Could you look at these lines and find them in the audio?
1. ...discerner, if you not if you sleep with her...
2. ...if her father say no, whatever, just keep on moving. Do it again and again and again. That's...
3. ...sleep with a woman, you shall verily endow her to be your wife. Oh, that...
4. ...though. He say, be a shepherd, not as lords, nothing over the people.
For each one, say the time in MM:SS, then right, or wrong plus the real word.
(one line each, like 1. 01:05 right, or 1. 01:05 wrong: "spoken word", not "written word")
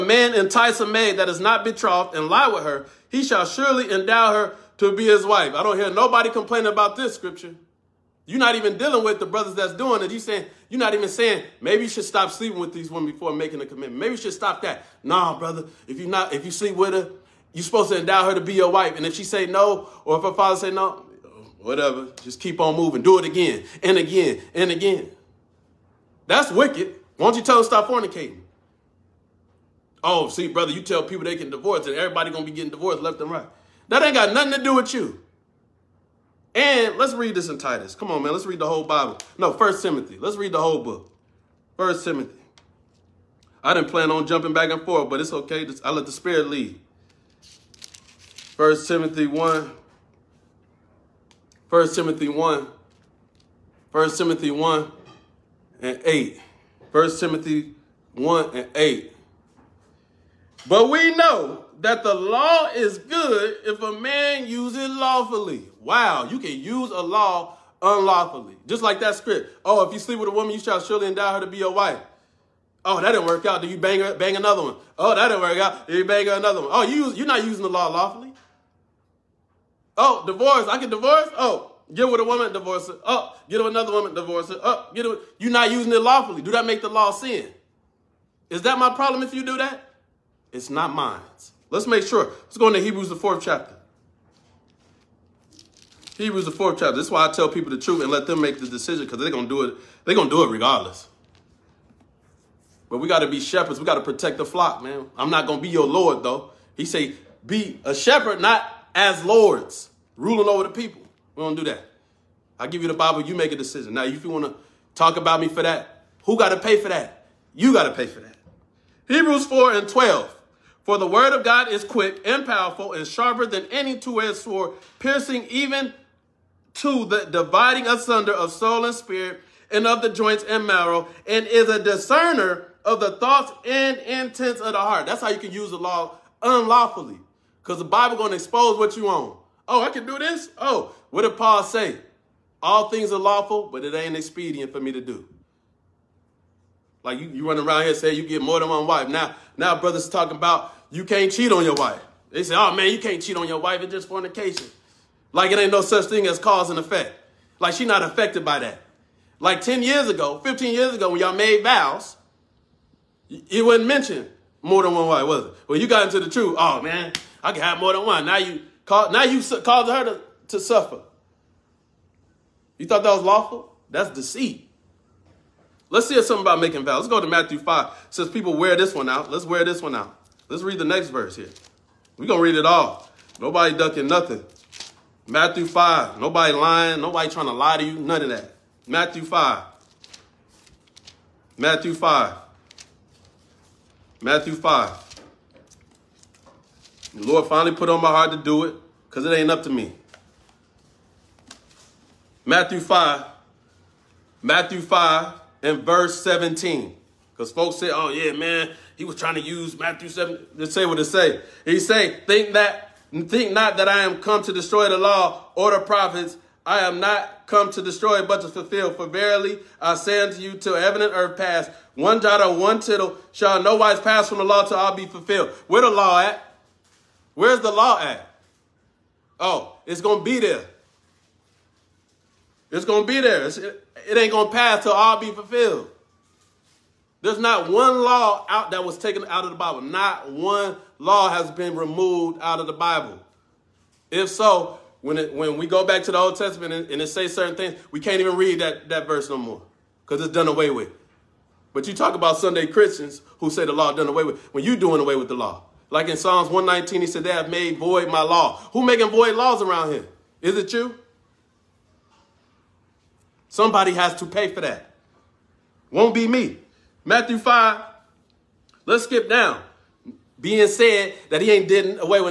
1. 00:15 wrong: "brother", not "discerner"
2. 00:20 right
3. 01:09 wrong: "surely", not "verily"
4. 01:46 wrong: "ruling", not "nothing".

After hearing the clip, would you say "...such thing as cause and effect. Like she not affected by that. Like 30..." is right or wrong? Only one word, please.
wrong.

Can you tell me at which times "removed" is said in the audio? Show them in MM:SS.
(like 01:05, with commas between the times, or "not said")
04:01.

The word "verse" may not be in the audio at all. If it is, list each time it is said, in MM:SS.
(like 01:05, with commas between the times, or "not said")
03:01, 03:25, 04:09.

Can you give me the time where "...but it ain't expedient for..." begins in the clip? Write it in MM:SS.
02:23.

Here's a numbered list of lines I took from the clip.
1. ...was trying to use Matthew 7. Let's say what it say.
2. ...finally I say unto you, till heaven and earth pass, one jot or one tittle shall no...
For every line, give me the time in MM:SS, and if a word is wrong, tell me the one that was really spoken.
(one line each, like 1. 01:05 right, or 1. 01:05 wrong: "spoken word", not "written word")
1. 03:29 right
2. 03:39 wrong: "verily", not "finally".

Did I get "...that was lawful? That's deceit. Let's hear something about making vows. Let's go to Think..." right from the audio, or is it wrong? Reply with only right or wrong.
wrong.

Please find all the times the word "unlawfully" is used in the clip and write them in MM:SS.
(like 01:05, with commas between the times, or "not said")
01:07, 02:16.